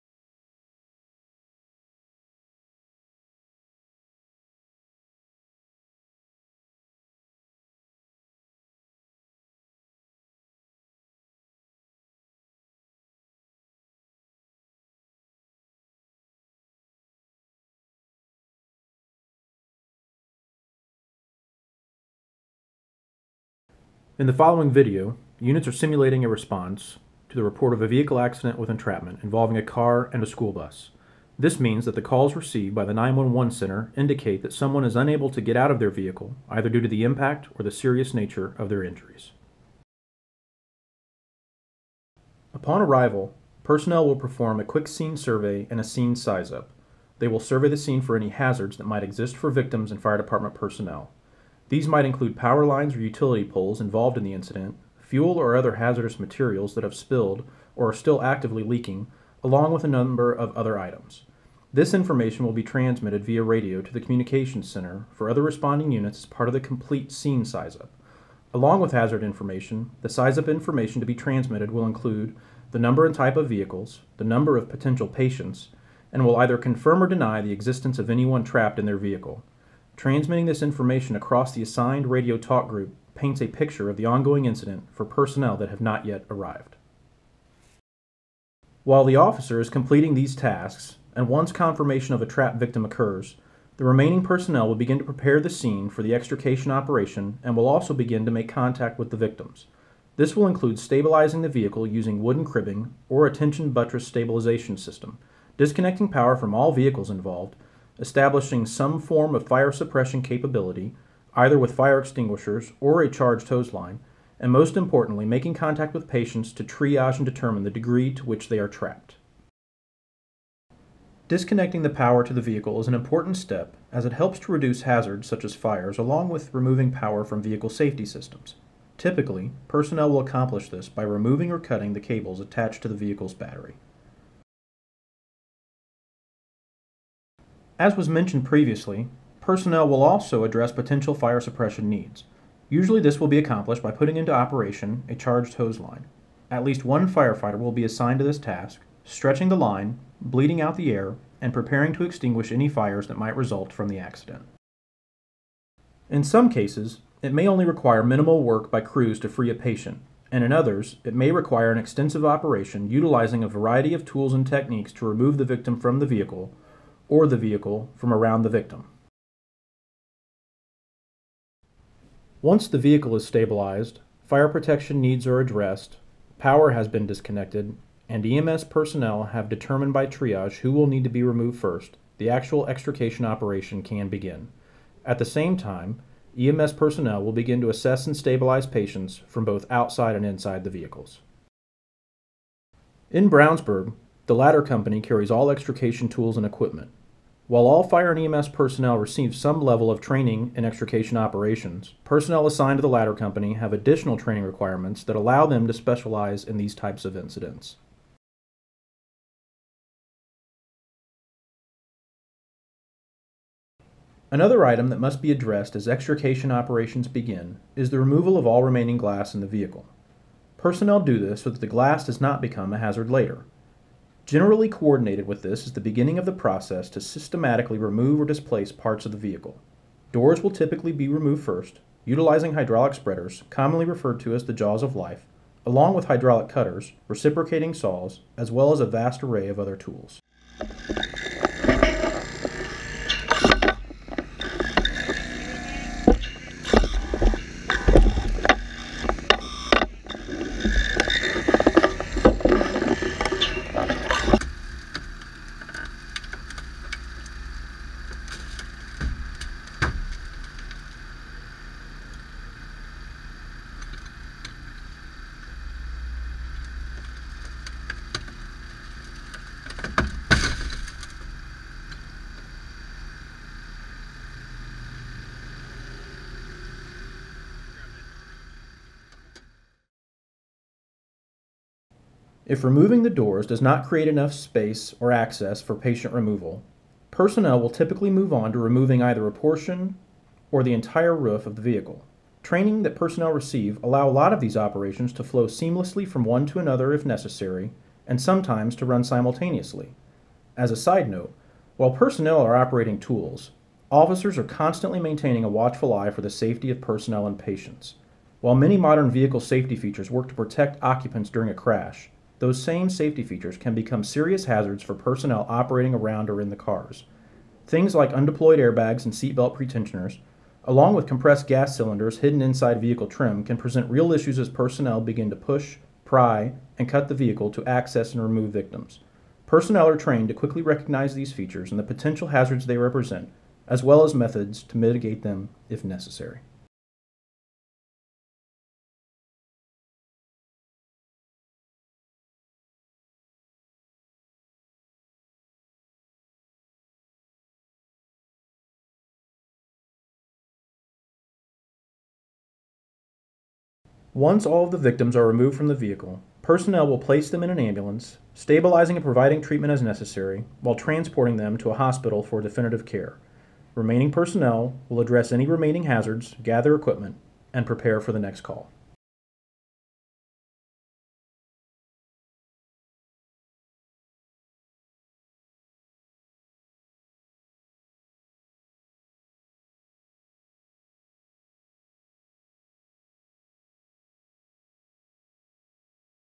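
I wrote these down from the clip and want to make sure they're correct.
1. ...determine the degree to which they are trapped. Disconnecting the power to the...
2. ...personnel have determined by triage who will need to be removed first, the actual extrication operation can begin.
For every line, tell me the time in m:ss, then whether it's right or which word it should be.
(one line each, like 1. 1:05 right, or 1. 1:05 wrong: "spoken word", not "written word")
1. 1:57 right
2. 2:58 right.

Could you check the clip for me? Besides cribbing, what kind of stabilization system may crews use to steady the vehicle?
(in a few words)
Tension buttress.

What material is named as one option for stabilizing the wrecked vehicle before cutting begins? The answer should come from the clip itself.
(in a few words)
Wooden cribbing.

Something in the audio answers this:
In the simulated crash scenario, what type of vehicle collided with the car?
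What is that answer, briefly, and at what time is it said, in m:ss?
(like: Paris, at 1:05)
School bus, at 0:30.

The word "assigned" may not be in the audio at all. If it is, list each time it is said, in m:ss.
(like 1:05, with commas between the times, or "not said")
1:21, 2:27, 3:22.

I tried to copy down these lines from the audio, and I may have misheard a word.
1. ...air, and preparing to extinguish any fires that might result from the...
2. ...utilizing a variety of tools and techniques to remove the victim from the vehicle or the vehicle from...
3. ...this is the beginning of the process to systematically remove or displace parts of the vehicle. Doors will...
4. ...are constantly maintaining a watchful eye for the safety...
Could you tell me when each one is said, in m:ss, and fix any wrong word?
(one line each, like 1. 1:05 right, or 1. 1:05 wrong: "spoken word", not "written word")
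1. 2:30 right
2. 2:42 right
3. 3:45 right
4. 5:04 right.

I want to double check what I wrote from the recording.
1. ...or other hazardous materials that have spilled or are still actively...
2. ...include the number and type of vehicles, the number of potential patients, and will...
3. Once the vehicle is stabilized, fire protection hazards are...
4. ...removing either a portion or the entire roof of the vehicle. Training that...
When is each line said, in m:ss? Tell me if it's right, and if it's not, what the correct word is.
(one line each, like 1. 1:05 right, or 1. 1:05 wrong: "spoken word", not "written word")
1. 0:55 right
2. 1:11 right
3. 2:52 wrong: "needs", not "hazards"
4. 4:48 right.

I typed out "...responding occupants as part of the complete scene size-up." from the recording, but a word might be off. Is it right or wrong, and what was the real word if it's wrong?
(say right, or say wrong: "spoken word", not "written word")
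wrong: "units", not "occupants".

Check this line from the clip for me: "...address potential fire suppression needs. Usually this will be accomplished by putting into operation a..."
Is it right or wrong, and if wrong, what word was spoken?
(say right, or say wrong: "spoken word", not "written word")
right.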